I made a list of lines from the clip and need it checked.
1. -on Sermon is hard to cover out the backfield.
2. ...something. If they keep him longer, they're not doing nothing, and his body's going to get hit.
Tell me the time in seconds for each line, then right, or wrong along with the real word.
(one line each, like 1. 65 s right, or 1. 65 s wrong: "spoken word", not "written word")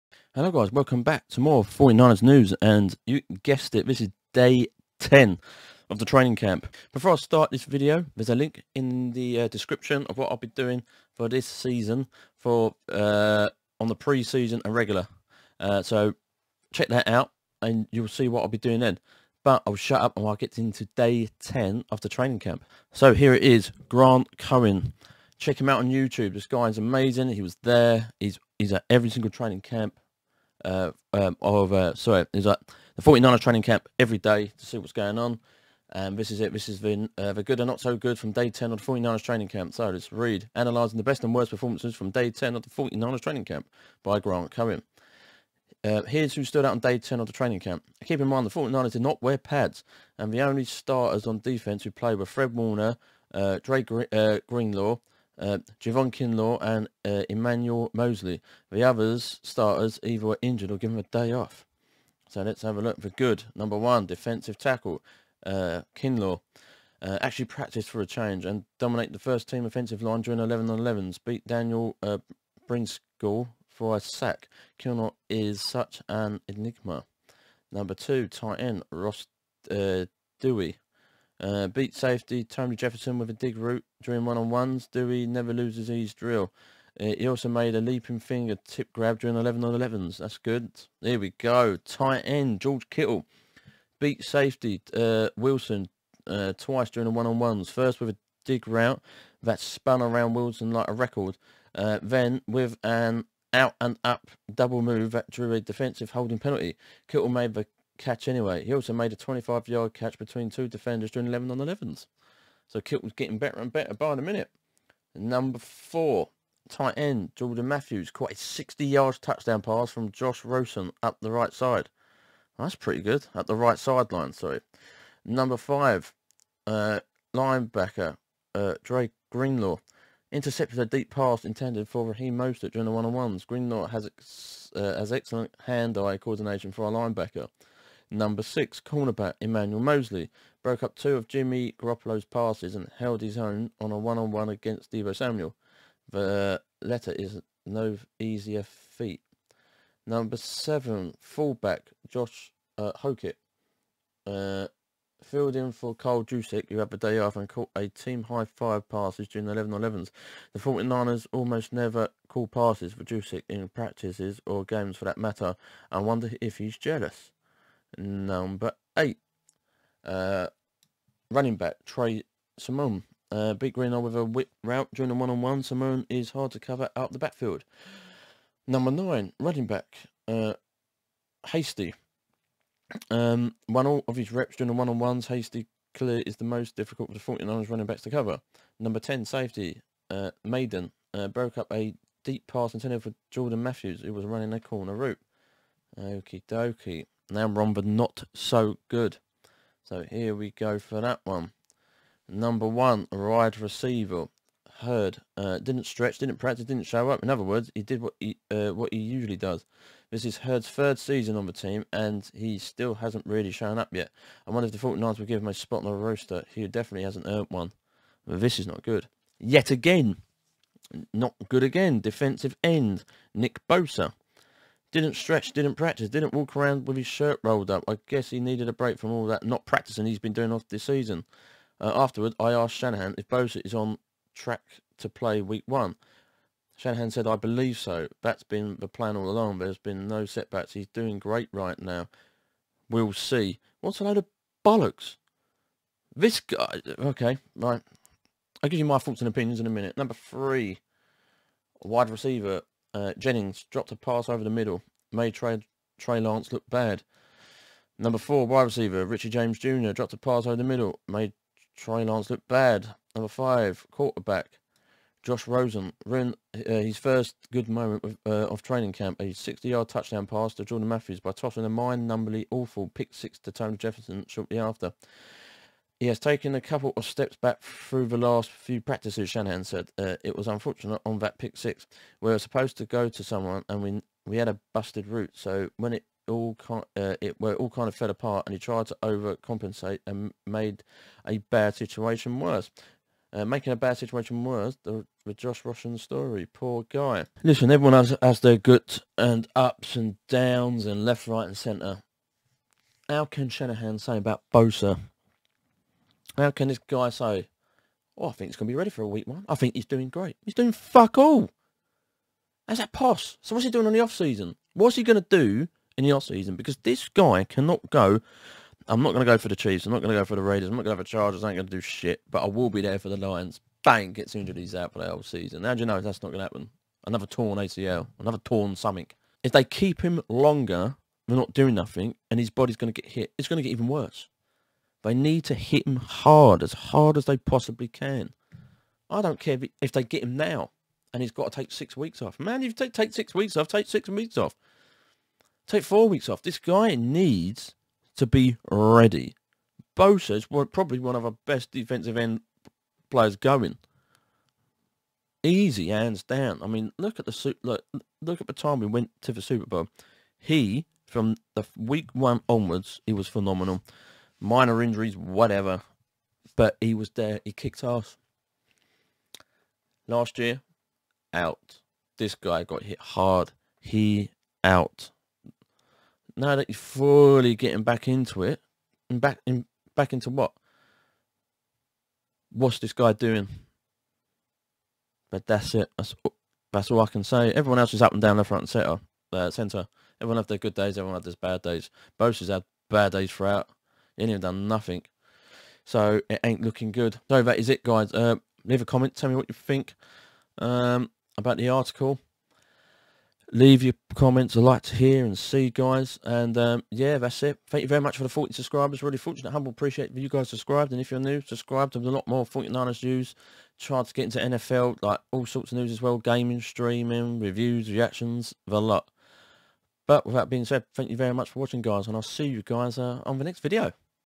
1. 175 s right
2. 328 s right.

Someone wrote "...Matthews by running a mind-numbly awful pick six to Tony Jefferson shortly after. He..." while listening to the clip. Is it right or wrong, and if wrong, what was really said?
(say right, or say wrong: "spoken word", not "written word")
wrong: "tossing", not "running".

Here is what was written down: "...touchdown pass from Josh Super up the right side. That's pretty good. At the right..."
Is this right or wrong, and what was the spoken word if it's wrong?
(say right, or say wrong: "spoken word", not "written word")
wrong: "Rosen", not "Super".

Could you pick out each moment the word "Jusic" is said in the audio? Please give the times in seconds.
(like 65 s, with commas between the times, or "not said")
156 s, 163 s.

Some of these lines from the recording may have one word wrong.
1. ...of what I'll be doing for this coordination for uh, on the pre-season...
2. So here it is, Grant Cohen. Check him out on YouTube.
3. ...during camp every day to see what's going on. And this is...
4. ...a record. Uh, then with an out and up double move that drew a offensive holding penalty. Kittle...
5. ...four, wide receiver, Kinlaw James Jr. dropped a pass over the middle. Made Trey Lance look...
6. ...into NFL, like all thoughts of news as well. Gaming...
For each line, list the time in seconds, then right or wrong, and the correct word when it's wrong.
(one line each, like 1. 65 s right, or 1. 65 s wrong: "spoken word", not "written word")
1. 10 s wrong: "season", not "coordination"
2. 22 s right
3. 33 s wrong: "training", not "during"
4. 100 s wrong: "defensive", not "offensive"
5. 258 s wrong: "Richie", not "Kinlaw"
6. 414 s wrong: "sorts", not "thoughts".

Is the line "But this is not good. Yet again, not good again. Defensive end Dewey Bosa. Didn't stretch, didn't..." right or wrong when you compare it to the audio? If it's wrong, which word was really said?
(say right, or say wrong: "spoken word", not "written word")
wrong: "Nick", not "Dewey".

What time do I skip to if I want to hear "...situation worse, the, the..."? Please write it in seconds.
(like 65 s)
293 s.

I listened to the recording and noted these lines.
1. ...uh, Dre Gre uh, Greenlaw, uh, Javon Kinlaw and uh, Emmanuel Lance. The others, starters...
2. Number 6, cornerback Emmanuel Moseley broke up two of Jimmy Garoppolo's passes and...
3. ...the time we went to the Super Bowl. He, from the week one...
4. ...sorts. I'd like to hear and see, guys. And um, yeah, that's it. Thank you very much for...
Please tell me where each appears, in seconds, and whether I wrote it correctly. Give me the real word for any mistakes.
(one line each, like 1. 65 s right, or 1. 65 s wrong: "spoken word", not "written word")
1. 53 s wrong: "Moseley", not "Lance"
2. 138 s right
3. 358 s right
4. 404 s wrong: "comments", not "sorts".